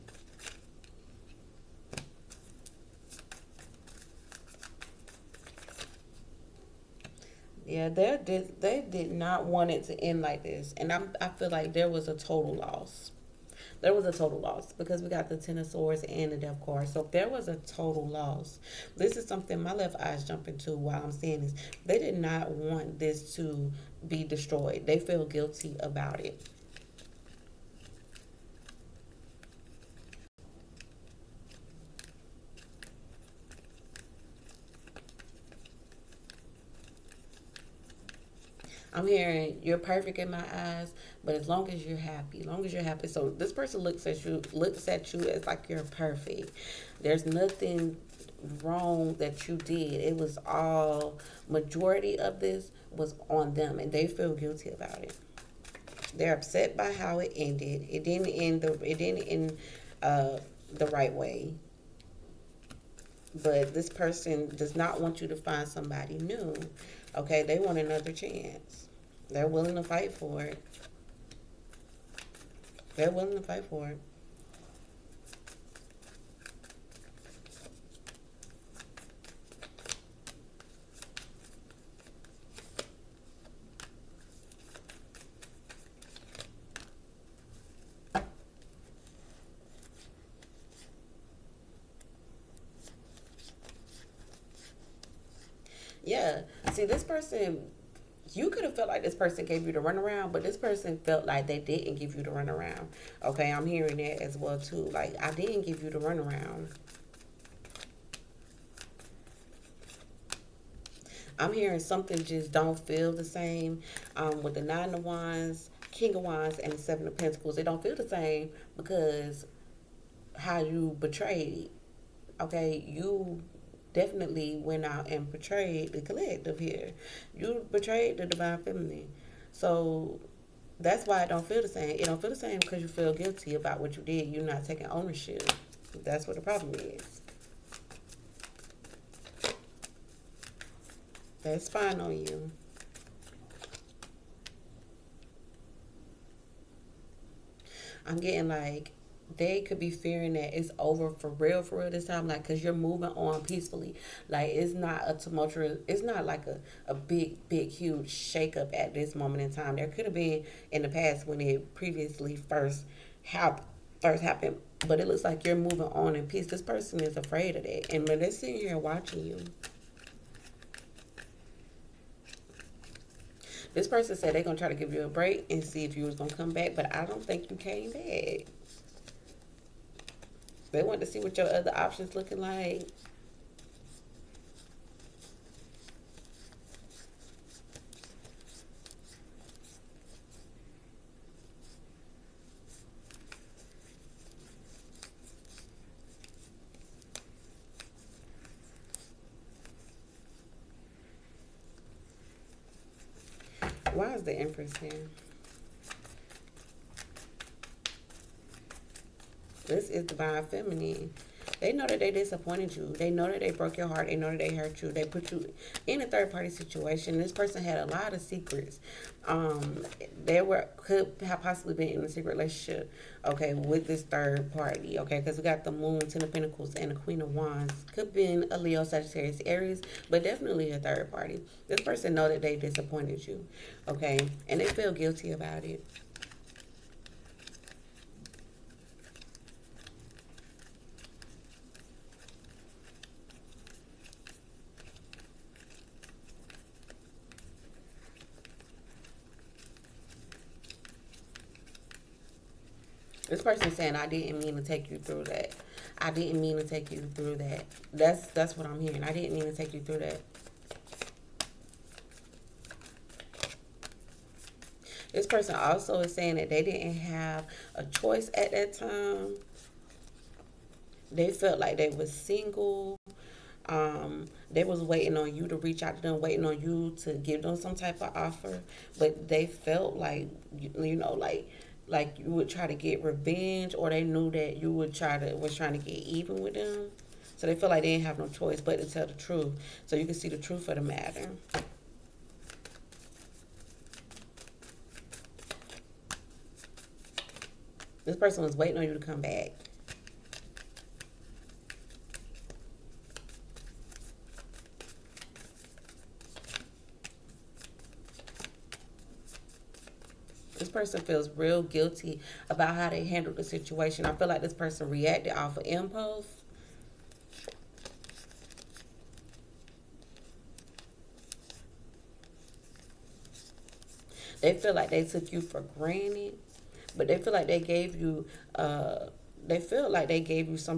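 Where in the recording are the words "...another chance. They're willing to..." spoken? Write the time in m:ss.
1:07.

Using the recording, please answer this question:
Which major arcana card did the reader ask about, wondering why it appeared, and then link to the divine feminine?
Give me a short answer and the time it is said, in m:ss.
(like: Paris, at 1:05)
The Empress, at 3:24.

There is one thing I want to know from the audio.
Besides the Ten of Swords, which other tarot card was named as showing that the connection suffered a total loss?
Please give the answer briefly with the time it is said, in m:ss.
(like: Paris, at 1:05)
Death, at 0:16.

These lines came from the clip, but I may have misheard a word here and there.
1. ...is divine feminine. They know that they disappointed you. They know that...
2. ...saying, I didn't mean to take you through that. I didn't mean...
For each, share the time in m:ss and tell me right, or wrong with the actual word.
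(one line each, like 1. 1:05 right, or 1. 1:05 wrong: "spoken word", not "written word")
1. 3:29 right
2. 4:13 right.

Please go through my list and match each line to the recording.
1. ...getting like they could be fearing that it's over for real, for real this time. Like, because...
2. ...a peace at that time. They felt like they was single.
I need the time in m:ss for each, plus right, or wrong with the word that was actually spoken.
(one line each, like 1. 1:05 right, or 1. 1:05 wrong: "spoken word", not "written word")
1. 2:28 right
2. 4:27 wrong: "choice", not "peace".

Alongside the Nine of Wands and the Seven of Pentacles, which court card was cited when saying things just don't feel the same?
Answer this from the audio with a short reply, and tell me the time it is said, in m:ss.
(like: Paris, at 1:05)
King of Wands, at 1:55.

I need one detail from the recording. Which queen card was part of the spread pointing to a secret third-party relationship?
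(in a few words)
Queen of Wands.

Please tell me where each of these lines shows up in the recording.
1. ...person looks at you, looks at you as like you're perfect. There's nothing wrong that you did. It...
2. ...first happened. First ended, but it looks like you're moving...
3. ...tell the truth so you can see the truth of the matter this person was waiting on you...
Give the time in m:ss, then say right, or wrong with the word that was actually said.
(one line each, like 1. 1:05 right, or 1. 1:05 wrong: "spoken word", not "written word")
1. 0:43 right
2. 2:42 wrong: "happened", not "ended"
3. 4:48 right.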